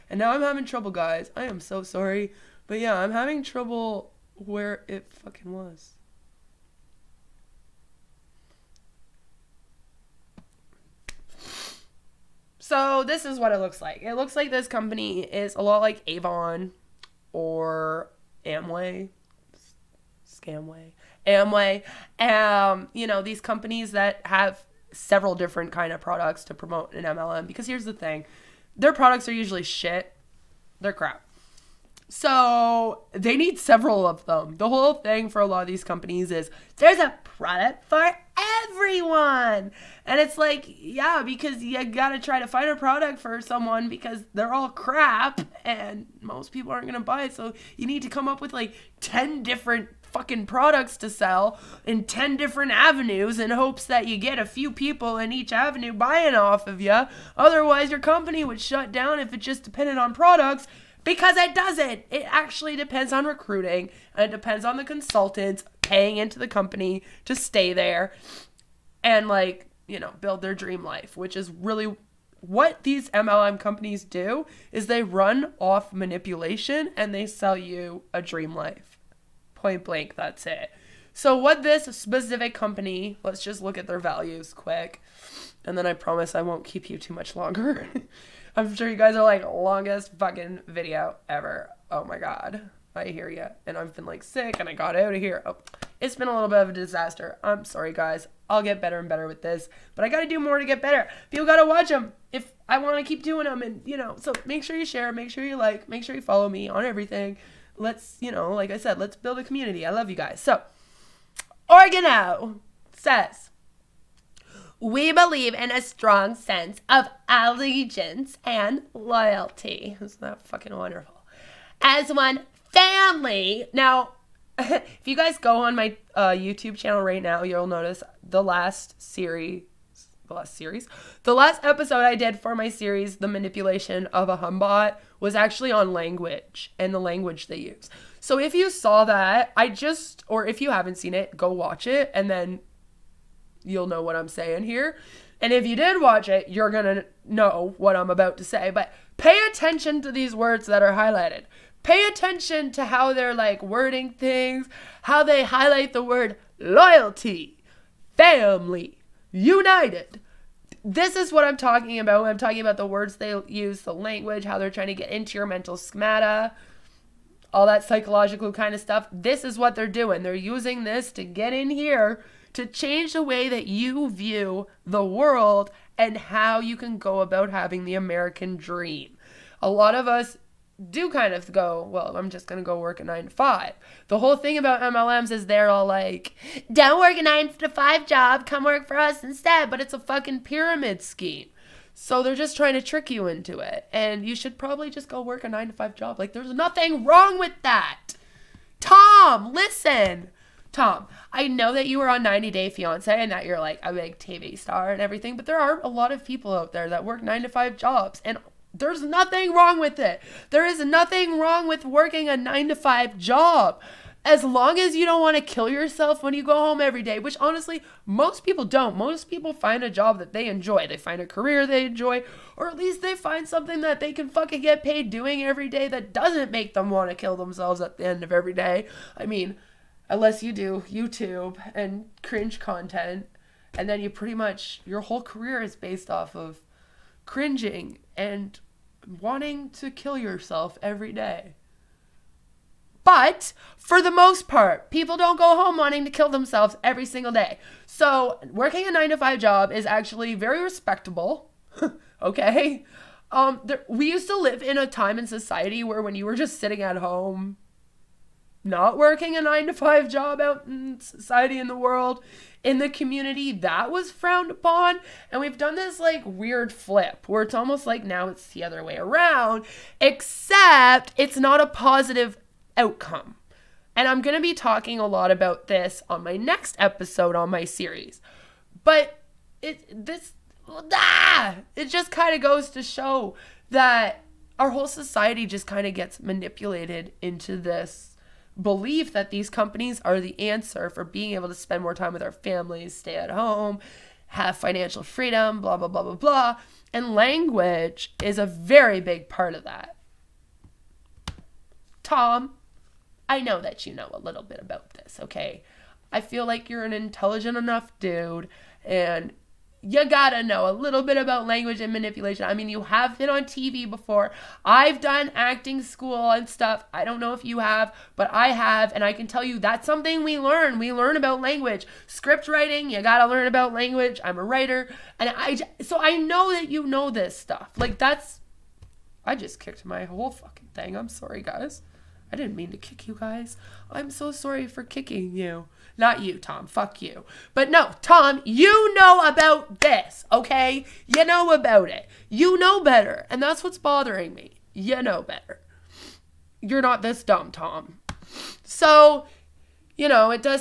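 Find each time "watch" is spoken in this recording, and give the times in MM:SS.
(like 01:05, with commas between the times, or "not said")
01:41, 02:21, 02:26.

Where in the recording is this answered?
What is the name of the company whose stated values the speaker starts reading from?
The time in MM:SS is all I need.
01:51.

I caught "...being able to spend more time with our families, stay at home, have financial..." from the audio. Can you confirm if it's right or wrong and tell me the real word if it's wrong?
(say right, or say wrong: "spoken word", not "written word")
right.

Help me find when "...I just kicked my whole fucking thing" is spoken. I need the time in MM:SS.
05:29.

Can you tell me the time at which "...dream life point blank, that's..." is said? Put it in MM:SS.
01:18.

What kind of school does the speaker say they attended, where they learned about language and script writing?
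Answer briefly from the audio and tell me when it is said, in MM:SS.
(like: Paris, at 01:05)
Acting school, at 05:15.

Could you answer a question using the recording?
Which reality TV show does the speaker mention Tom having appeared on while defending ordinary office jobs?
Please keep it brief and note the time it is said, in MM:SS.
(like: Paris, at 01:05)
90 Day Fiance, at 03:22.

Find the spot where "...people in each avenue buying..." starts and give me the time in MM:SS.
00:54.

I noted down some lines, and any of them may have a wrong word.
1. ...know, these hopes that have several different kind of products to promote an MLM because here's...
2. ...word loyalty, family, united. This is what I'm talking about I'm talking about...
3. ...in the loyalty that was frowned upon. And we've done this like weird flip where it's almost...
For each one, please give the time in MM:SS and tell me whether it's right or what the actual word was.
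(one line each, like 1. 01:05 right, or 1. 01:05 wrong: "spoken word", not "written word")
1. 00:23 wrong: "companies", not "hopes"
2. 02:36 right
3. 04:22 wrong: "community", not "loyalty".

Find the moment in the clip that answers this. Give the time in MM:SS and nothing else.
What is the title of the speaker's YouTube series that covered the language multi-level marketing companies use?
02:13.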